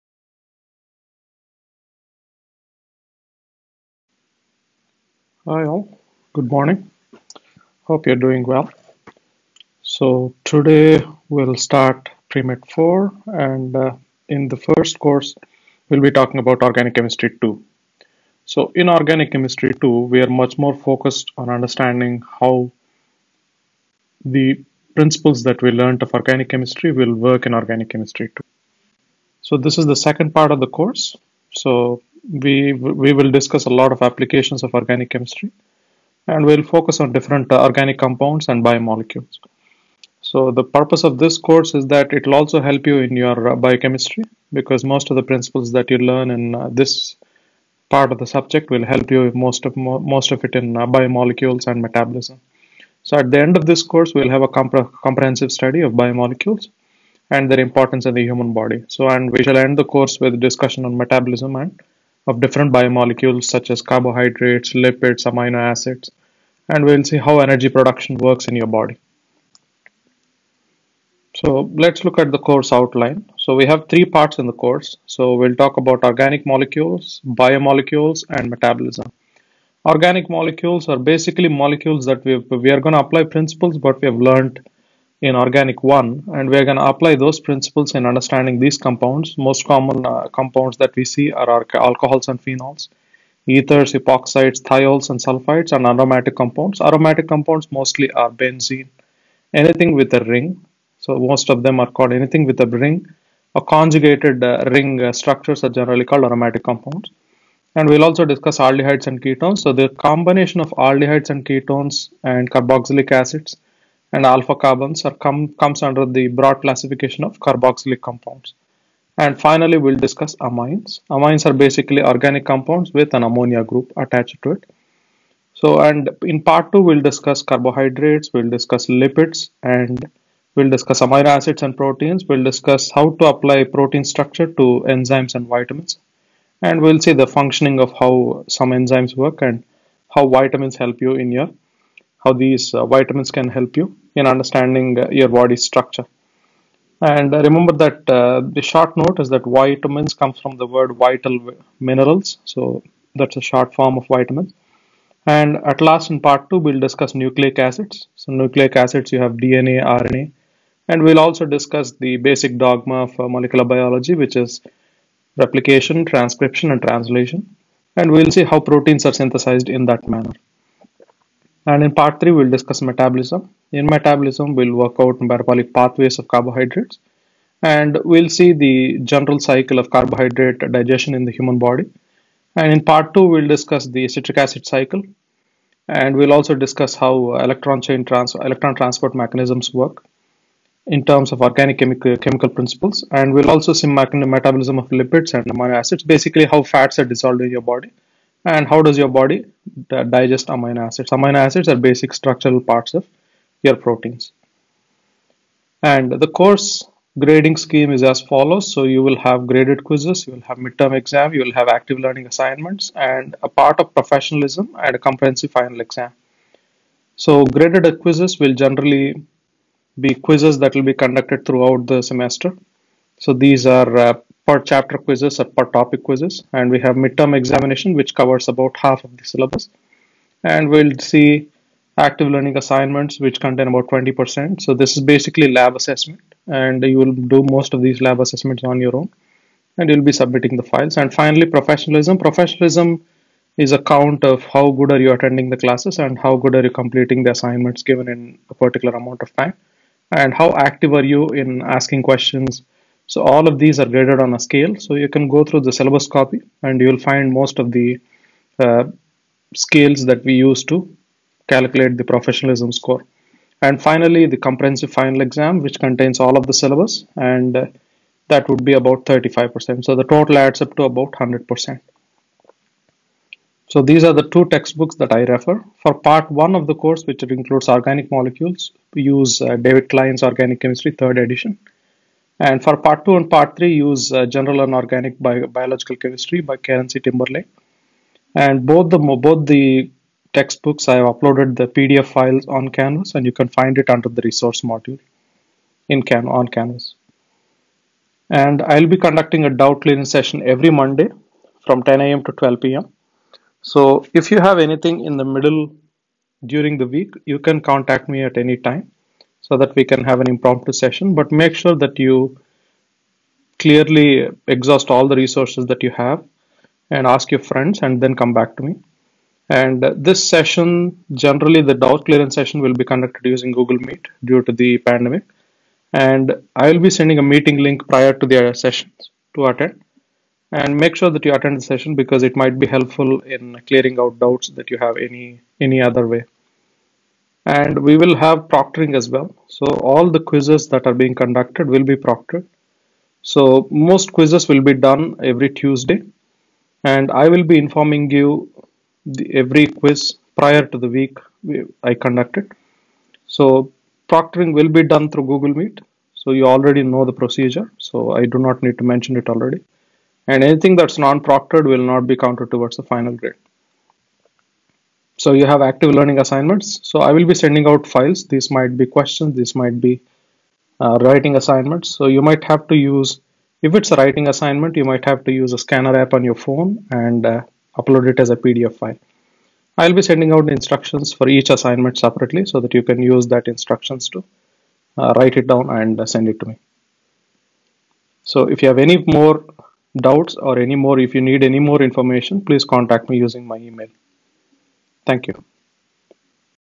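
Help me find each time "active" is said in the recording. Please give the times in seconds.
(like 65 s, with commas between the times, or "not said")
211 s, 231 s, 250 s, 365 s.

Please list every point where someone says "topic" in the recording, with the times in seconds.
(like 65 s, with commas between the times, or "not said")
225 s.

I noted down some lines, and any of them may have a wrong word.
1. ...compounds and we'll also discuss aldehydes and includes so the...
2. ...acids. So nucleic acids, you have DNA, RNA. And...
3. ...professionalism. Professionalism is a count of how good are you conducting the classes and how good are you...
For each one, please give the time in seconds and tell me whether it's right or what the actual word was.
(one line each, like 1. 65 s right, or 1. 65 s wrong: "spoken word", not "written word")
1. 106 s wrong: "ketones", not "includes"
2. 157 s right
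3. 241 s wrong: "attending", not "conducting".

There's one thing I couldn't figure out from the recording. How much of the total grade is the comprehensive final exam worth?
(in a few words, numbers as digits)
35%.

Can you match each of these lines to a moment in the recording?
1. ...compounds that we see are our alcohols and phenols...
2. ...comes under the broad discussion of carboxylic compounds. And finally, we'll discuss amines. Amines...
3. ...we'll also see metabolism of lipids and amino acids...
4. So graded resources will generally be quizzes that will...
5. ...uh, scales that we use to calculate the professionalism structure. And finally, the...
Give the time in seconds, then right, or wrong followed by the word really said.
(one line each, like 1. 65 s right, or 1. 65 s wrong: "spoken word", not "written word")
1. 90 s right
2. 115 s wrong: "classification", not "discussion"
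3. 193 s right
4. 217 s wrong: "quizzes", not "resources"
5. 258 s wrong: "score", not "structure".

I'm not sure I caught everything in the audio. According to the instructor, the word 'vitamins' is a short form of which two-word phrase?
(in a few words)
vital minerals.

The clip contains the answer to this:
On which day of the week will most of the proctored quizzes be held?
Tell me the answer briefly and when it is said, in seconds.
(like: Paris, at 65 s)
Tuesday, at 345 s.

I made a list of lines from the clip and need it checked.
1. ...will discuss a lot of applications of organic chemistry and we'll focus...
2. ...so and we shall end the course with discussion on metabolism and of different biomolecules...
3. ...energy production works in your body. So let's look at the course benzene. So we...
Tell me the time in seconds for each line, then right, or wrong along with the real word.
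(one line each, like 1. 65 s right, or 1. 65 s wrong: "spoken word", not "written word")
1. 33 s right
2. 58 s right
3. 67 s wrong: "outline", not "benzene".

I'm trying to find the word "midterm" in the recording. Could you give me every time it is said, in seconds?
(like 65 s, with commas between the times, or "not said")
210 s, 226 s.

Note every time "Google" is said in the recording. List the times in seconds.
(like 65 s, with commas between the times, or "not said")
323 s, 355 s.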